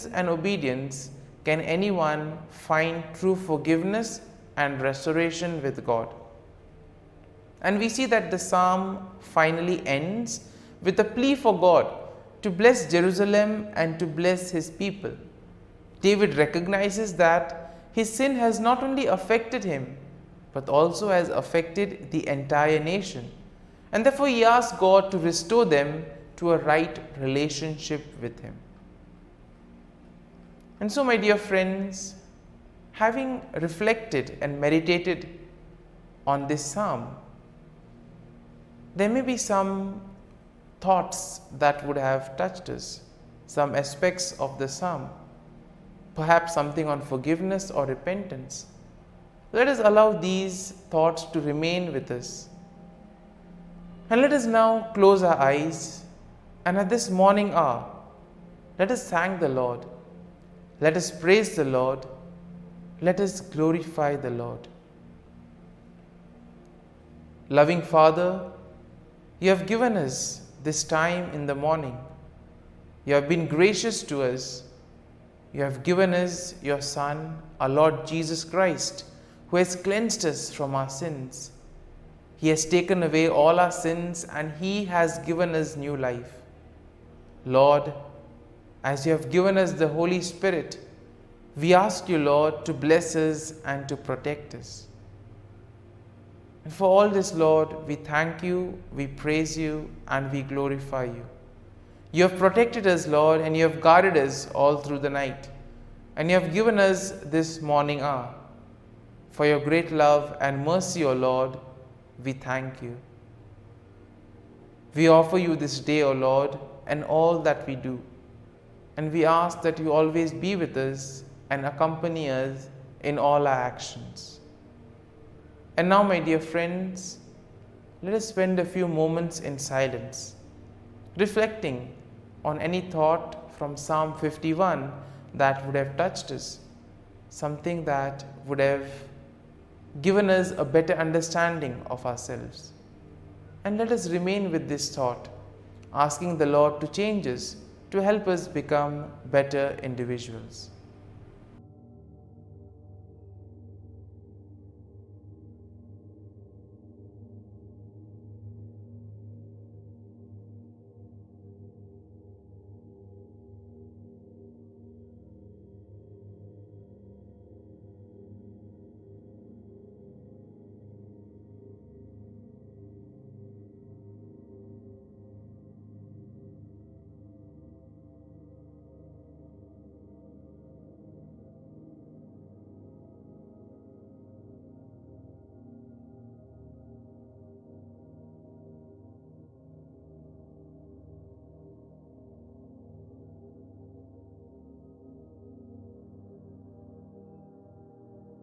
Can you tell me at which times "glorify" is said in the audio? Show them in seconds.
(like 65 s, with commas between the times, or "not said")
63 s, 100 s.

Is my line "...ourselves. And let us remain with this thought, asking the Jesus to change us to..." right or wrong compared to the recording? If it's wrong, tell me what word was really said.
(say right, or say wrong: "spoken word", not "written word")
wrong: "Lord", not "Jesus".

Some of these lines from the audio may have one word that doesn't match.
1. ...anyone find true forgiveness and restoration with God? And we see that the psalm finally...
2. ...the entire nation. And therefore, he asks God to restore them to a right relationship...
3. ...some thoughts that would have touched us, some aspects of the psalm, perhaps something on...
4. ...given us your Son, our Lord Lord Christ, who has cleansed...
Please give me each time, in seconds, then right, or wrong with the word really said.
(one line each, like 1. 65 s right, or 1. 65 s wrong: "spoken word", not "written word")
1. 1 s right
2. 22 s right
3. 39 s right
4. 75 s wrong: "Jesus", not "Lord".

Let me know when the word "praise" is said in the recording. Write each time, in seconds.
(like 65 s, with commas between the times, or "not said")
61 s, 99 s.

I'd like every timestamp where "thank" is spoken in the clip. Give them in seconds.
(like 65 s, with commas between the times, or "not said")
59 s, 97 s, 112 s.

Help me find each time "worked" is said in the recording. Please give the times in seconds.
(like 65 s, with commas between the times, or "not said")
not said.